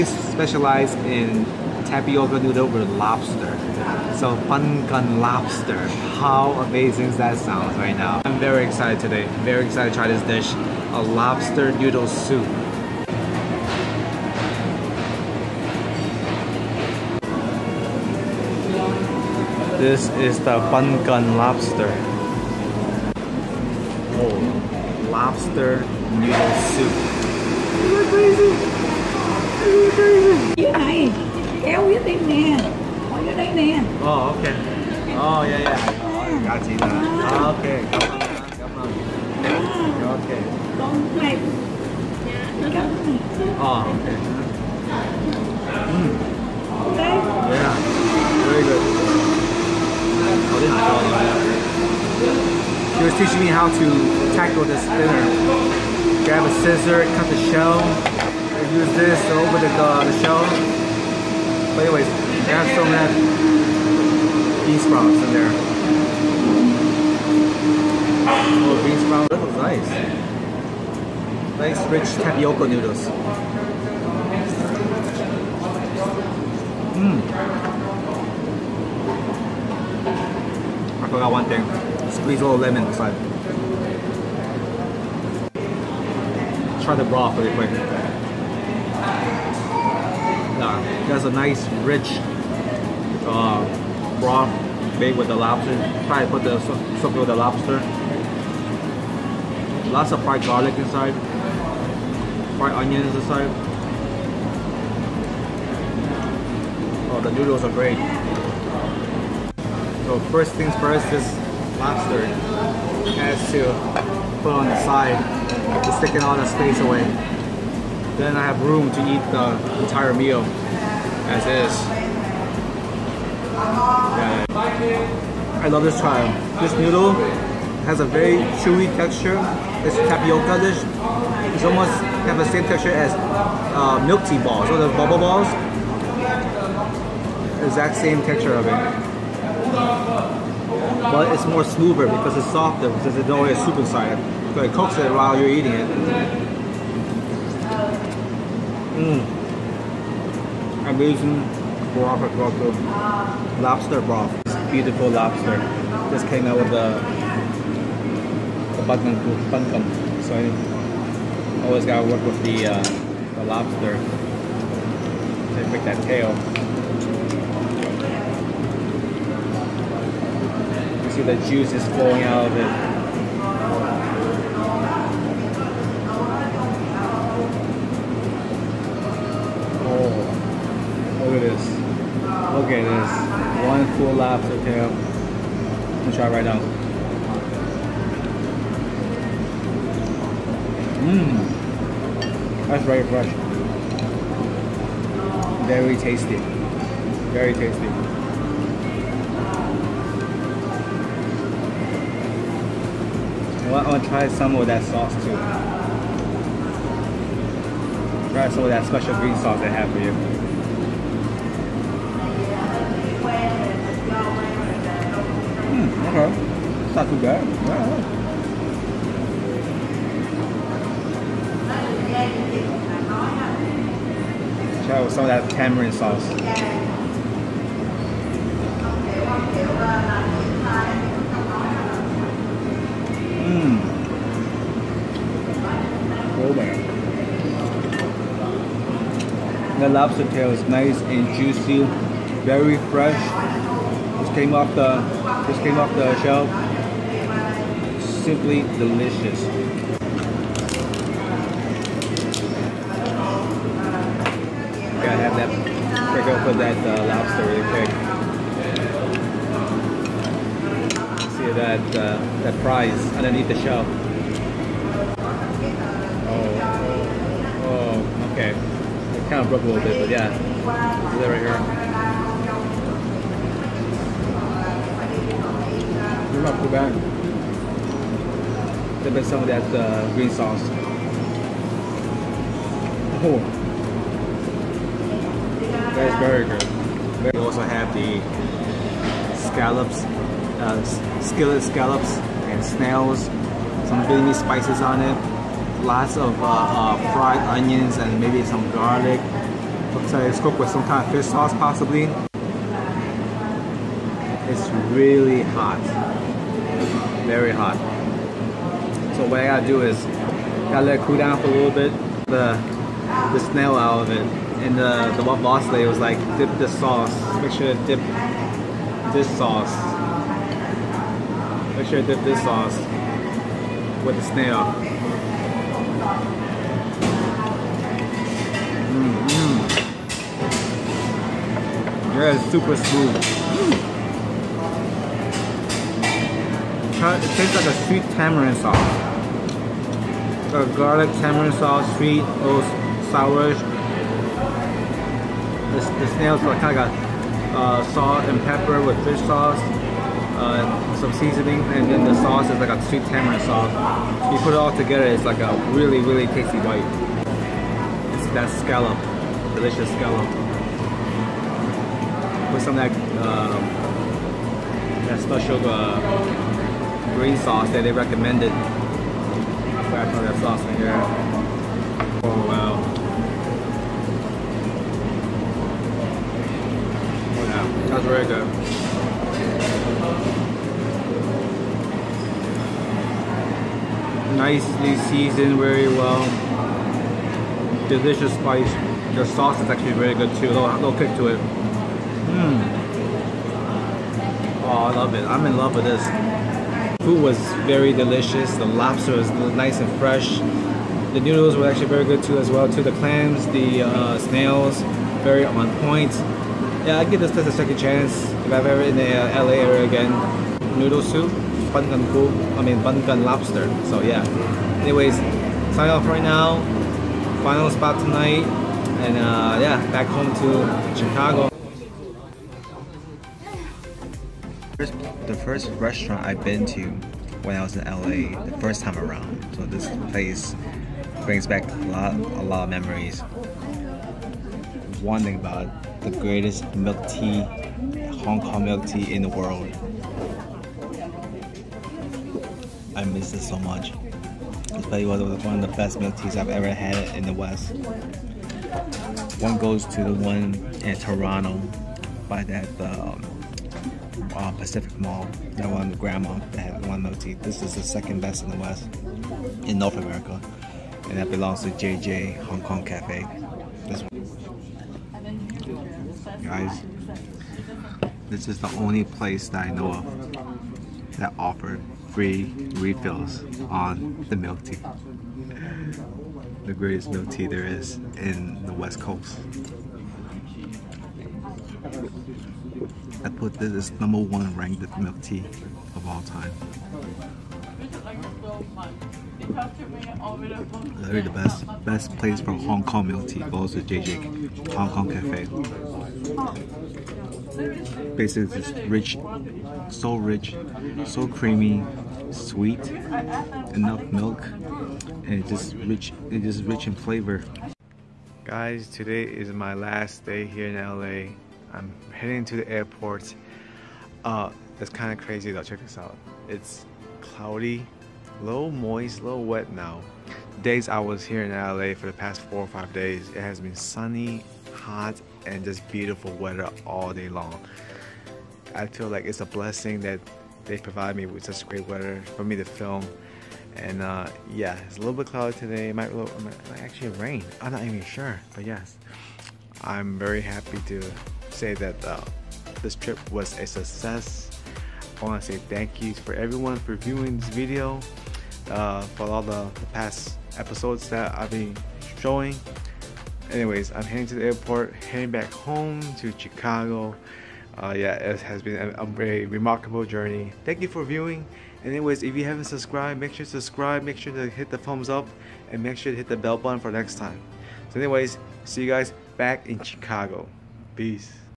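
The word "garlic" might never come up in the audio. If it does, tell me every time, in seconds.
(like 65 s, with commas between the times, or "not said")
100 s, 298 s, 340 s.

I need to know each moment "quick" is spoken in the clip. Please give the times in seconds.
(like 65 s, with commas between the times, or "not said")
87 s, 260 s.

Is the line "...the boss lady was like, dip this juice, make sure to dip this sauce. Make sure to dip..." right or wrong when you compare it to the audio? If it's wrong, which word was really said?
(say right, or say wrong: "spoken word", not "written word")
wrong: "sauce", not "juice".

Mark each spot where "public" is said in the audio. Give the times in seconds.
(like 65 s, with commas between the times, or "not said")
not said.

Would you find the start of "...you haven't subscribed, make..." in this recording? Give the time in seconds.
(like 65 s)
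562 s.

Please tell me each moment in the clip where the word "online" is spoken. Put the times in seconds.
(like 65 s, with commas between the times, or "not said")
not said.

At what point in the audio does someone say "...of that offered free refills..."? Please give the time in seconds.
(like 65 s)
469 s.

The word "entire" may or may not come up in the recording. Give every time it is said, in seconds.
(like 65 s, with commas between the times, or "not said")
119 s.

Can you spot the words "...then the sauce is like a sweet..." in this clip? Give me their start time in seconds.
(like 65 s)
351 s.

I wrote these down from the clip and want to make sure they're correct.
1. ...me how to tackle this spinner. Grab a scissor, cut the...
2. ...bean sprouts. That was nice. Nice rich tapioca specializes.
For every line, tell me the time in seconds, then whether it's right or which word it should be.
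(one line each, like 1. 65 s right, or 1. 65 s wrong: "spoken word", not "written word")
1. 53 s right
2. 68 s wrong: "noodles", not "specializes".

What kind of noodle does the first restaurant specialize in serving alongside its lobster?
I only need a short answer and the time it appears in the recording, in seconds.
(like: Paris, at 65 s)
Tapioca noodle, at 1 s.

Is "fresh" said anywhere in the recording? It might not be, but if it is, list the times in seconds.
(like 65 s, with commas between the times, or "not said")
193 s, 242 s, 399 s.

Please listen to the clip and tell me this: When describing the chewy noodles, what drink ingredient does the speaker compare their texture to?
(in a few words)
Milk tea balls.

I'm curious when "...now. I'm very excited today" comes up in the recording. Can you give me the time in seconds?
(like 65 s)
7 s.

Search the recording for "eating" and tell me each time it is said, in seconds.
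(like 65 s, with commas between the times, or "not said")
145 s.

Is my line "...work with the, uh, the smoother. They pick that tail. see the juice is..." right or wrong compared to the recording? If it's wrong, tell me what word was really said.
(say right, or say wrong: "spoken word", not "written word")
wrong: "lobster", not "smoother".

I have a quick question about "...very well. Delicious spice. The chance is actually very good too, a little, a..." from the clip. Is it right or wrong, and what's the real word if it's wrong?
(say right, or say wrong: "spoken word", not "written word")
wrong: "sauce", not "chance".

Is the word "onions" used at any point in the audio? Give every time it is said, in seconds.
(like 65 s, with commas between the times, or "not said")
102 s, 297 s.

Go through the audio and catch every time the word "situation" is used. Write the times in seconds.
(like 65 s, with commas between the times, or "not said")
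not said.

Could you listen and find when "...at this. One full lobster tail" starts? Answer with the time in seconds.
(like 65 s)
182 s.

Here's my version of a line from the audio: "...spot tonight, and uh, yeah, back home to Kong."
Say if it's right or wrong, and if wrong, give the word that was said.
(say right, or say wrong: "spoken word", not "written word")
wrong: "Chicago", not "Kong".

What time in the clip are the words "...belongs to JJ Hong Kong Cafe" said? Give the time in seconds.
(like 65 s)
461 s.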